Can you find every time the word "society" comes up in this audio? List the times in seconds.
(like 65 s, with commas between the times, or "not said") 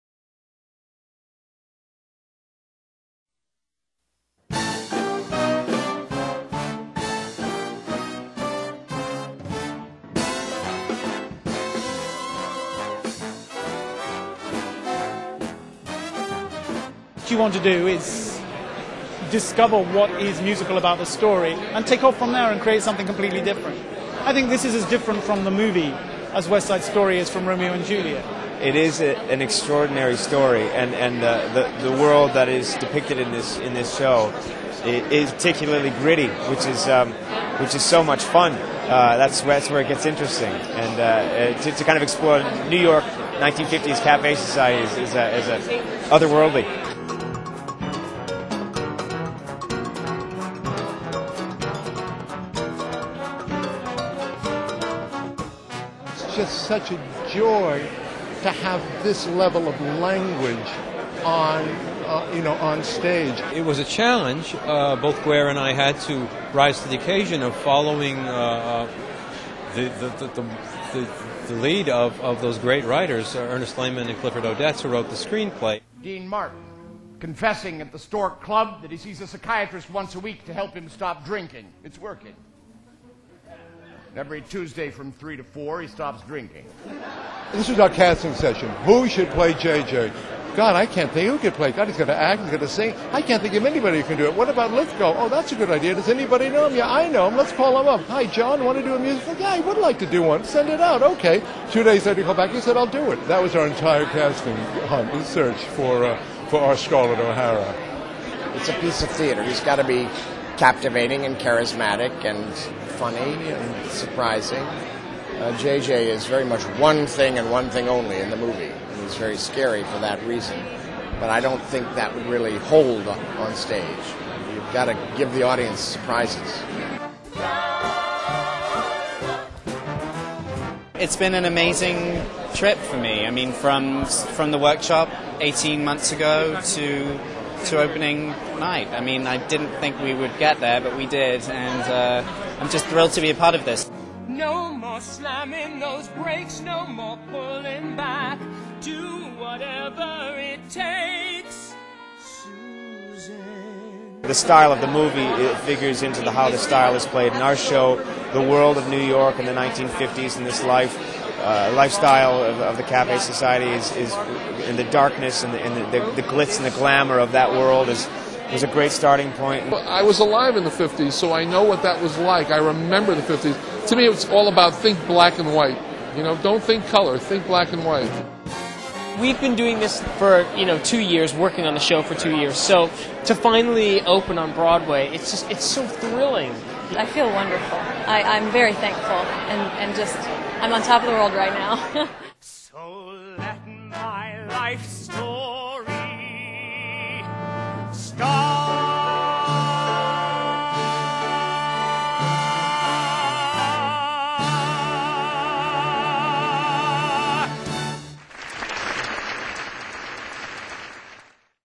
44 s, 163 s.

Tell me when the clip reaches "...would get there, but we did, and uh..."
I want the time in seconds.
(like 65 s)
140 s.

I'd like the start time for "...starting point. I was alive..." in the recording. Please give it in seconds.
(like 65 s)
168 s.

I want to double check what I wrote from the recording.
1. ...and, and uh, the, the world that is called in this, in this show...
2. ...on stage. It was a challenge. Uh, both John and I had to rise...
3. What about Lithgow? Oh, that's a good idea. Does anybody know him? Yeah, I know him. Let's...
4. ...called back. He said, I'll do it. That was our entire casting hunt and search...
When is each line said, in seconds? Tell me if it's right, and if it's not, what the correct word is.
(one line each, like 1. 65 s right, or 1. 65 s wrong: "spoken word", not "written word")
1. 30 s wrong: "depicted", not "called"
2. 62 s wrong: "Guare", not "John"
3. 94 s right
4. 102 s right.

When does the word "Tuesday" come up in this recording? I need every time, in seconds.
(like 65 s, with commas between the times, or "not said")
84 s.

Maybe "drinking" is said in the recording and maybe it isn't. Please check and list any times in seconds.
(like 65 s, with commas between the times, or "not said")
81 s, 86 s.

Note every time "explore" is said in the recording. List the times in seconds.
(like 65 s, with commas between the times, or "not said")
42 s.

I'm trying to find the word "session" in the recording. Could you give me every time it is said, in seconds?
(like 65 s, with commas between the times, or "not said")
88 s.